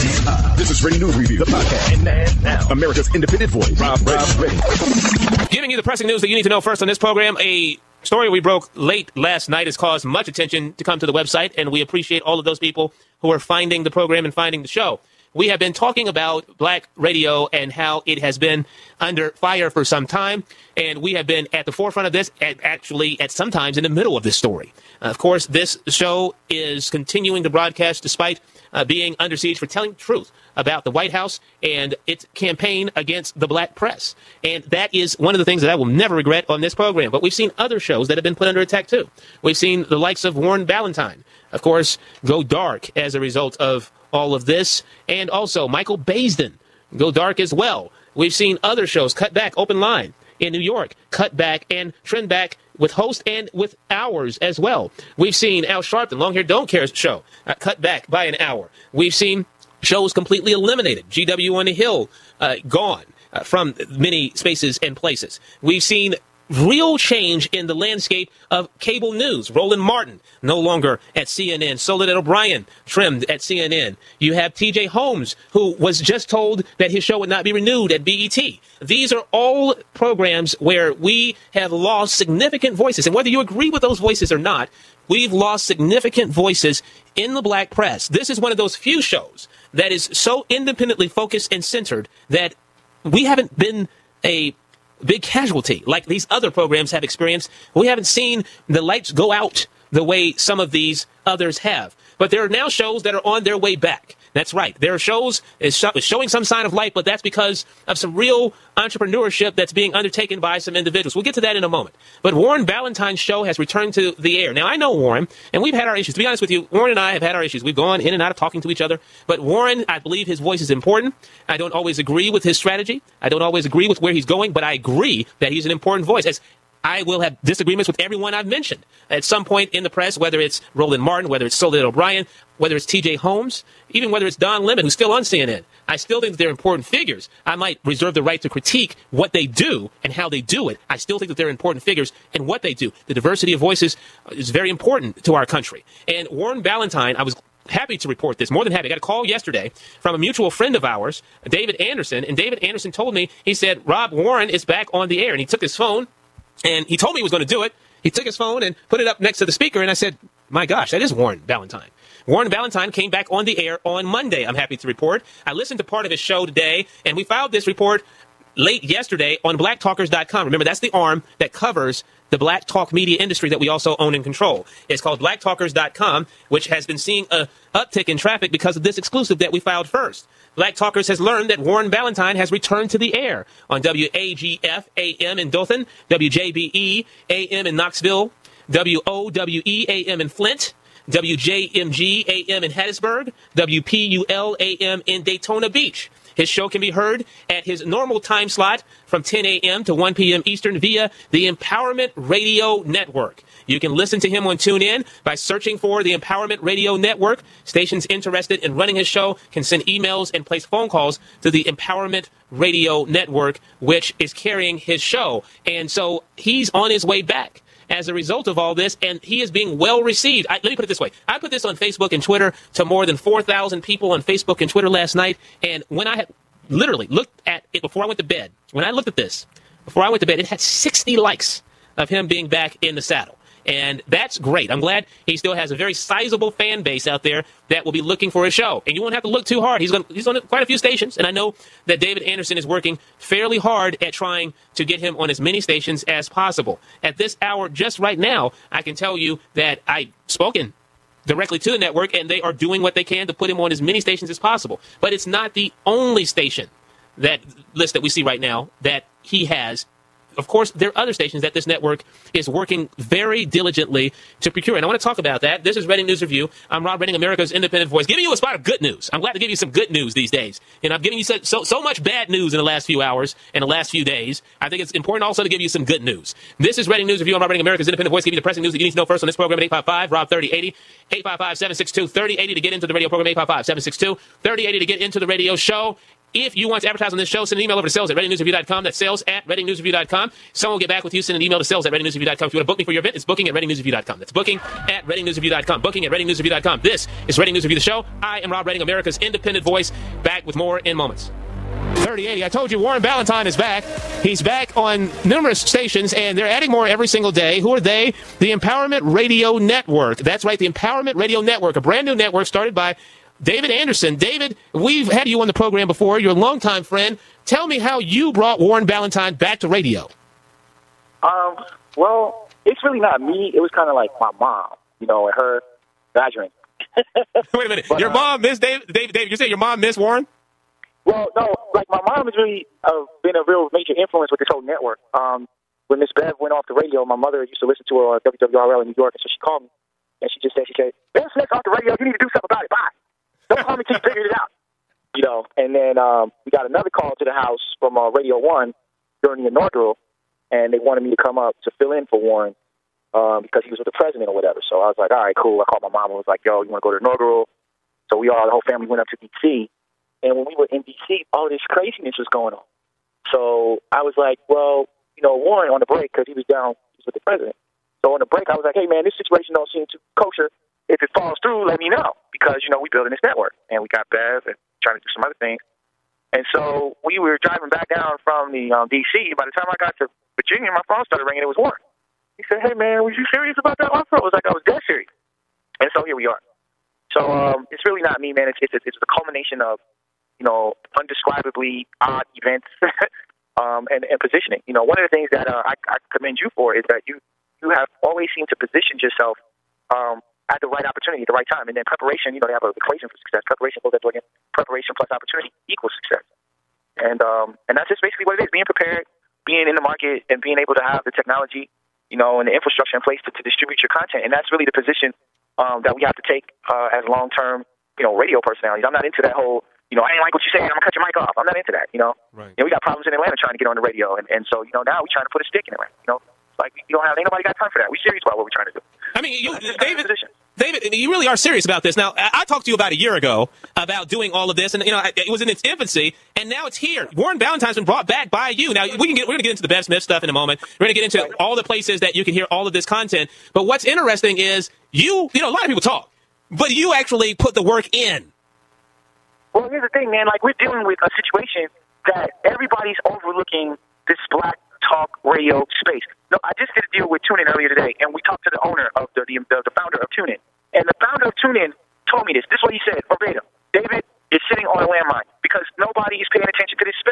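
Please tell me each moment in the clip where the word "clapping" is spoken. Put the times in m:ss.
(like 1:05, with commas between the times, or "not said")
not said.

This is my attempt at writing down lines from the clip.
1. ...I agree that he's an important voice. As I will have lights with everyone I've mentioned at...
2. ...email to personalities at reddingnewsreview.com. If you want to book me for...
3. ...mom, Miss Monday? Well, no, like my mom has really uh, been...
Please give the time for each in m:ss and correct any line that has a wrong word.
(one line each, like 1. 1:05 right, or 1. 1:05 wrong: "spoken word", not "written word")
1. 2:04 wrong: "disagreements", not "lights"
2. 4:51 wrong: "sales", not "personalities"
3. 5:29 wrong: "Warren", not "Monday".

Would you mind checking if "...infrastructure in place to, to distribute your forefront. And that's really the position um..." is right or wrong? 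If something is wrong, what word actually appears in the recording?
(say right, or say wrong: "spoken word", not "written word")
wrong: "content", not "forefront".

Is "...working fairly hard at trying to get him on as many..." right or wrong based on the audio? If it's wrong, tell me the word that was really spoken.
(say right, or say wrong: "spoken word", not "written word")
right.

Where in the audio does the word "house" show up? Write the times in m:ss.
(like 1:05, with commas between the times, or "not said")
0:31, 5:47.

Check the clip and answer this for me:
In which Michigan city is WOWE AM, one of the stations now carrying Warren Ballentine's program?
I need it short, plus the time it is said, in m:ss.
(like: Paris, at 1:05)
Flint, at 3:10.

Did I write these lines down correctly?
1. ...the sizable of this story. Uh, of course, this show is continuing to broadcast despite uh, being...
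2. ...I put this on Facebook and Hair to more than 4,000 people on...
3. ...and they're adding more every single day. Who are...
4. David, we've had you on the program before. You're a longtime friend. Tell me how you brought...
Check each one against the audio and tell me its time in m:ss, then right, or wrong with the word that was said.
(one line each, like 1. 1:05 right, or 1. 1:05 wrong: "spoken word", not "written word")
1. 0:23 wrong: "middle", not "sizable"
2. 3:41 wrong: "Twitter", not "Hair"
3. 5:06 right
4. 5:14 right.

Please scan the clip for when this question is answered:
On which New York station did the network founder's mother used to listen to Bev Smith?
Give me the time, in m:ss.
5:38.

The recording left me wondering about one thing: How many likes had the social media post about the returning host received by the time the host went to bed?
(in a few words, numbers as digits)
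60.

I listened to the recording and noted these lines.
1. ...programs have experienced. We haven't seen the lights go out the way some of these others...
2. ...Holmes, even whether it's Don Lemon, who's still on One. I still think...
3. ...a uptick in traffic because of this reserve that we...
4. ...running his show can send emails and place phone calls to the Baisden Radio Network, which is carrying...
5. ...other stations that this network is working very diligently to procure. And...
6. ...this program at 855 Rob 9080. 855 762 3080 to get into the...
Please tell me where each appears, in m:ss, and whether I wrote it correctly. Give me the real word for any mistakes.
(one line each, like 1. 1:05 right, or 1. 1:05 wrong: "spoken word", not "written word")
1. 1:36 right
2. 2:13 wrong: "CNN", not "One"
3. 2:57 wrong: "exclusive", not "reserve"
4. 3:28 wrong: "Empowerment", not "Baisden"
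5. 4:21 right
6. 4:39 wrong: "3080", not "9080".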